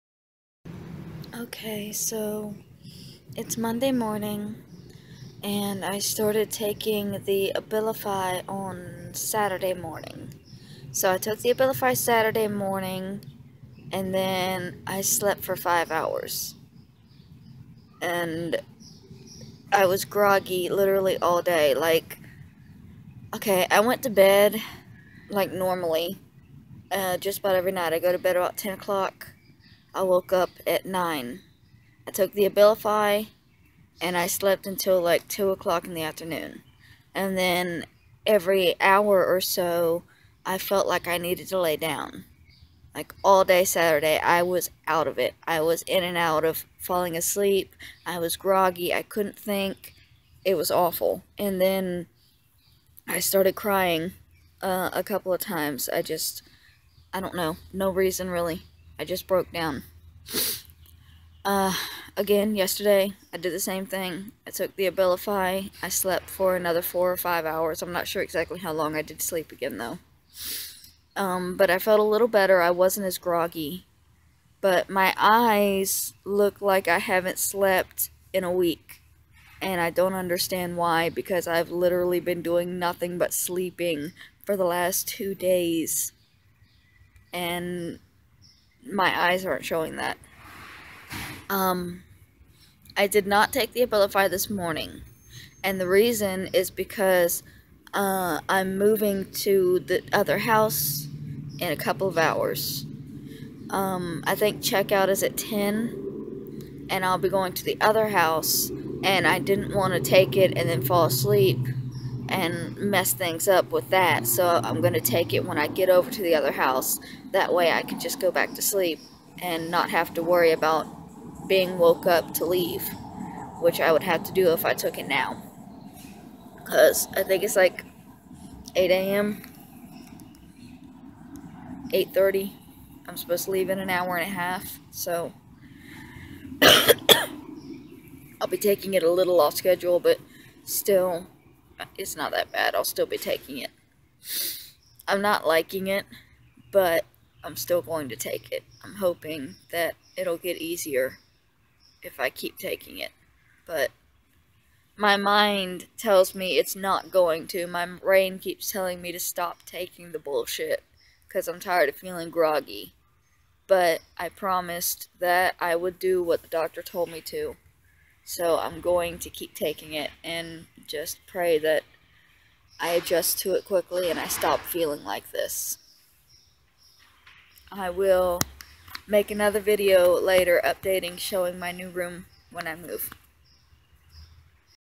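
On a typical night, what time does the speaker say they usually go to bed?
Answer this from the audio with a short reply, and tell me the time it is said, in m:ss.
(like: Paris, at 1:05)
10 o'clock, at 0:28.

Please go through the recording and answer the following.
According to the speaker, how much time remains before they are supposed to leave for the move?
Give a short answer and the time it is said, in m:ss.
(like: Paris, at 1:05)
an hour and a half, at 2:13.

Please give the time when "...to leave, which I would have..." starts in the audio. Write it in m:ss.
2:02.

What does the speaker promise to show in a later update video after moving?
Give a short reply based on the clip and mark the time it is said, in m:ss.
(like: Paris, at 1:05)
my new room, at 3:01.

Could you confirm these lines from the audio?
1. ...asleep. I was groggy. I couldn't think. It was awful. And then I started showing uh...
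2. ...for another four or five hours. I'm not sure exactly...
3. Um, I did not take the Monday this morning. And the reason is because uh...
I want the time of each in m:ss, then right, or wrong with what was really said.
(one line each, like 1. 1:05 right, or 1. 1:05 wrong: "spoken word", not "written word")
1. 0:47 wrong: "crying", not "showing"
2. 1:06 right
3. 1:31 wrong: "Abilify", not "Monday".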